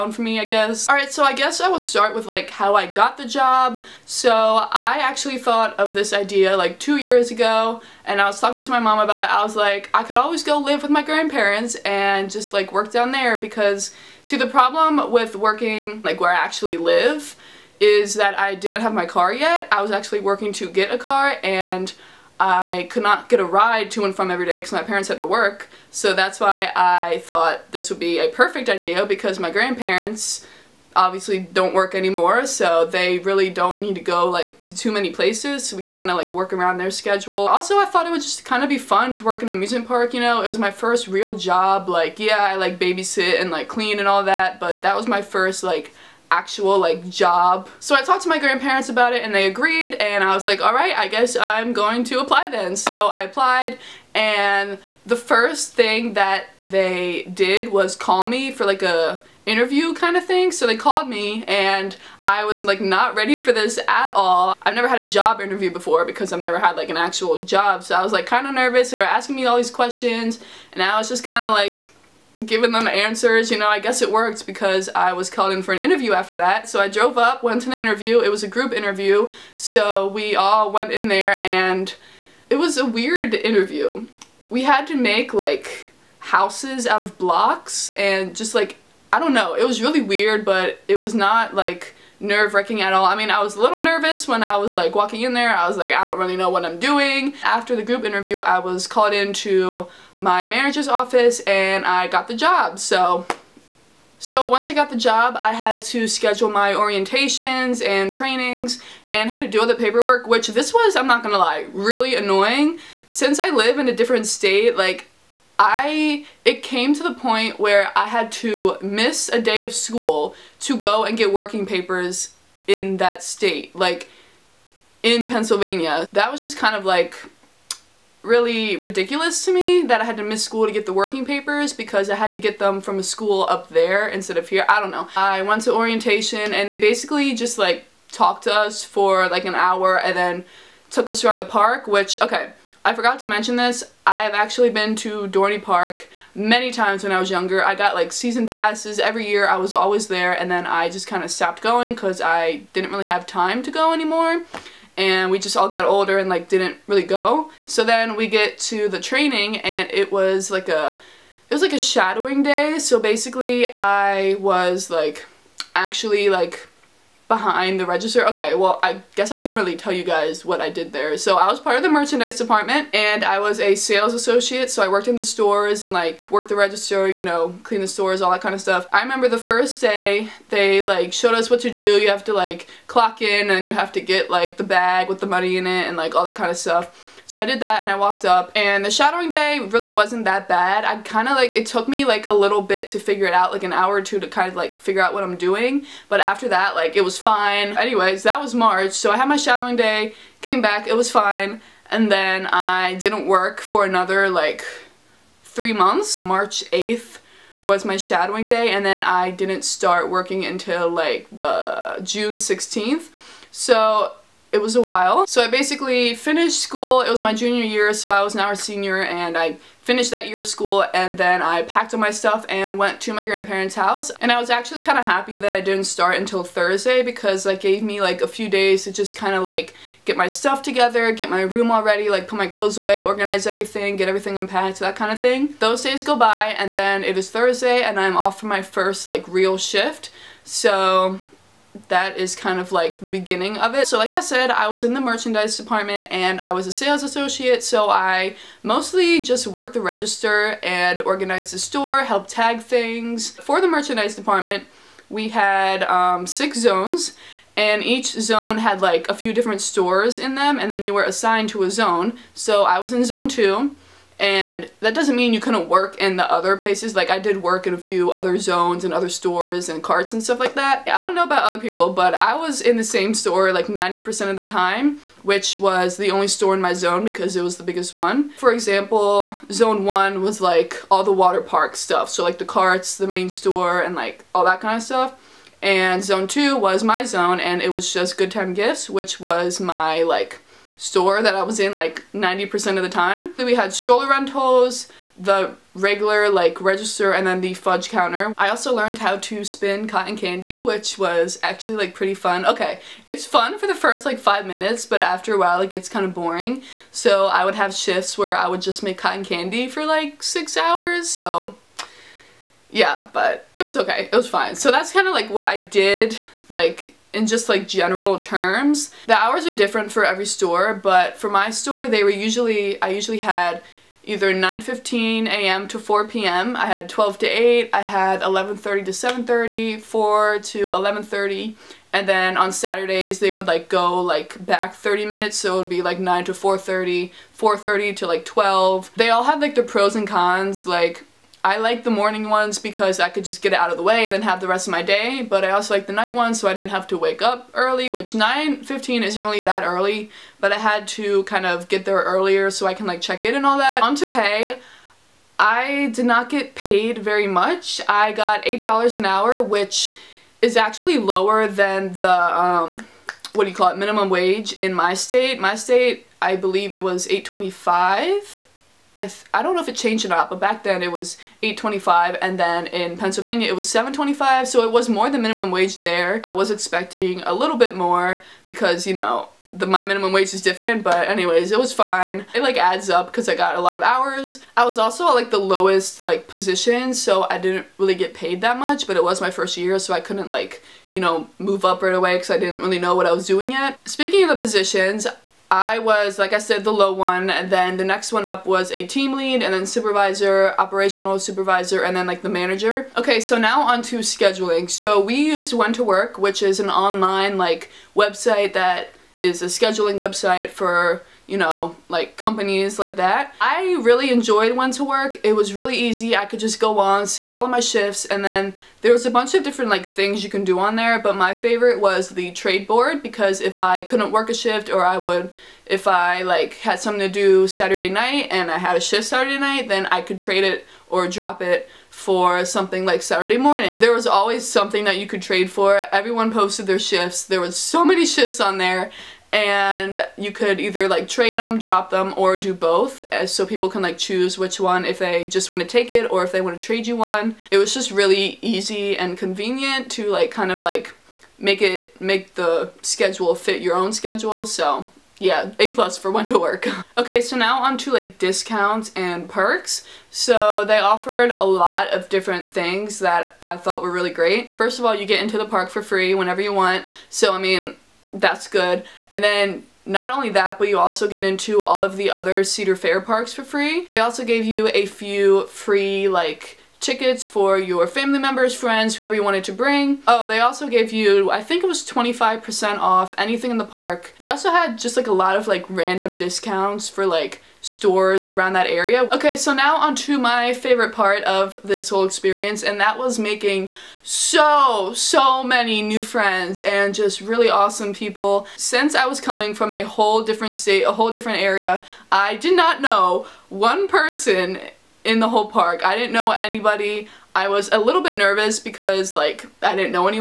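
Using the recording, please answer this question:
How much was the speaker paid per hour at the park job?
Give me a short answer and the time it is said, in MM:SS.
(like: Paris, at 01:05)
$8, at 05:58.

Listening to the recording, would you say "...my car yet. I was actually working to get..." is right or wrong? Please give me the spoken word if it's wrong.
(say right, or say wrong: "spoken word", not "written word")
right.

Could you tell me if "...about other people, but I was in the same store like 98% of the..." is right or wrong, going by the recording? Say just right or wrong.
wrong.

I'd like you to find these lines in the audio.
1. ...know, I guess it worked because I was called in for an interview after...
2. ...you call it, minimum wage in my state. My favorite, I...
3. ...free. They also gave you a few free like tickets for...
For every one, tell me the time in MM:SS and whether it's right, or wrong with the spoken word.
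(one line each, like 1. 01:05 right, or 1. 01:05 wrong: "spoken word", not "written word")
1. 01:13 right
2. 06:03 wrong: "state", not "favorite"
3. 07:53 right.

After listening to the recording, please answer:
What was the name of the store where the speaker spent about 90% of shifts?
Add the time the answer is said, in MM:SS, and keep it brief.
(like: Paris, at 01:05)
Good Time Gifts, at 04:48.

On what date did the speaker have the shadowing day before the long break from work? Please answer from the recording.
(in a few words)
March 8.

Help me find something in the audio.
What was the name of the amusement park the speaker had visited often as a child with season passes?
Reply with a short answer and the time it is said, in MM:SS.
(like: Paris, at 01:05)
Dorney Park, at 02:25.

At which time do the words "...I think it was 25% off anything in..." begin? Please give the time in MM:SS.
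08:01.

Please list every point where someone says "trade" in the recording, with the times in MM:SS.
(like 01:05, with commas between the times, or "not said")
07:02, 07:10, 07:15, 07:26.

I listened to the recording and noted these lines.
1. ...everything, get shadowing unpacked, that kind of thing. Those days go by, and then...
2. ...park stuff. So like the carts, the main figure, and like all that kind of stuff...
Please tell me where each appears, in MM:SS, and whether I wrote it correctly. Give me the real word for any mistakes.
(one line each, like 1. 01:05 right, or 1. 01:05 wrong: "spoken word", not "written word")
1. 03:53 wrong: "everything", not "shadowing"
2. 04:41 wrong: "store", not "figure".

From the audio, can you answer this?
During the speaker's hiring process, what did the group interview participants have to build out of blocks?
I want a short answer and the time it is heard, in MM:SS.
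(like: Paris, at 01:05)
Houses, at 01:26.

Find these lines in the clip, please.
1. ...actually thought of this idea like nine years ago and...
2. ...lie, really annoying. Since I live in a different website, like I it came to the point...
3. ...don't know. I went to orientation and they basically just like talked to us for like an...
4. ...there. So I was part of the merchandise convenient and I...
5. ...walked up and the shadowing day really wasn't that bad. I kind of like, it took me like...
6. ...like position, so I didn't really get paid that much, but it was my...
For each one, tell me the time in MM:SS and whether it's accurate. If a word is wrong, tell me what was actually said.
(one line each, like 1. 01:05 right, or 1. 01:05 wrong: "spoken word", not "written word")
1. 00:04 wrong: "two", not "nine"
2. 01:51 wrong: "state", not "website"
3. 02:14 right
4. 02:50 wrong: "department", not "convenient"
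5. 03:07 right
6. 06:25 right.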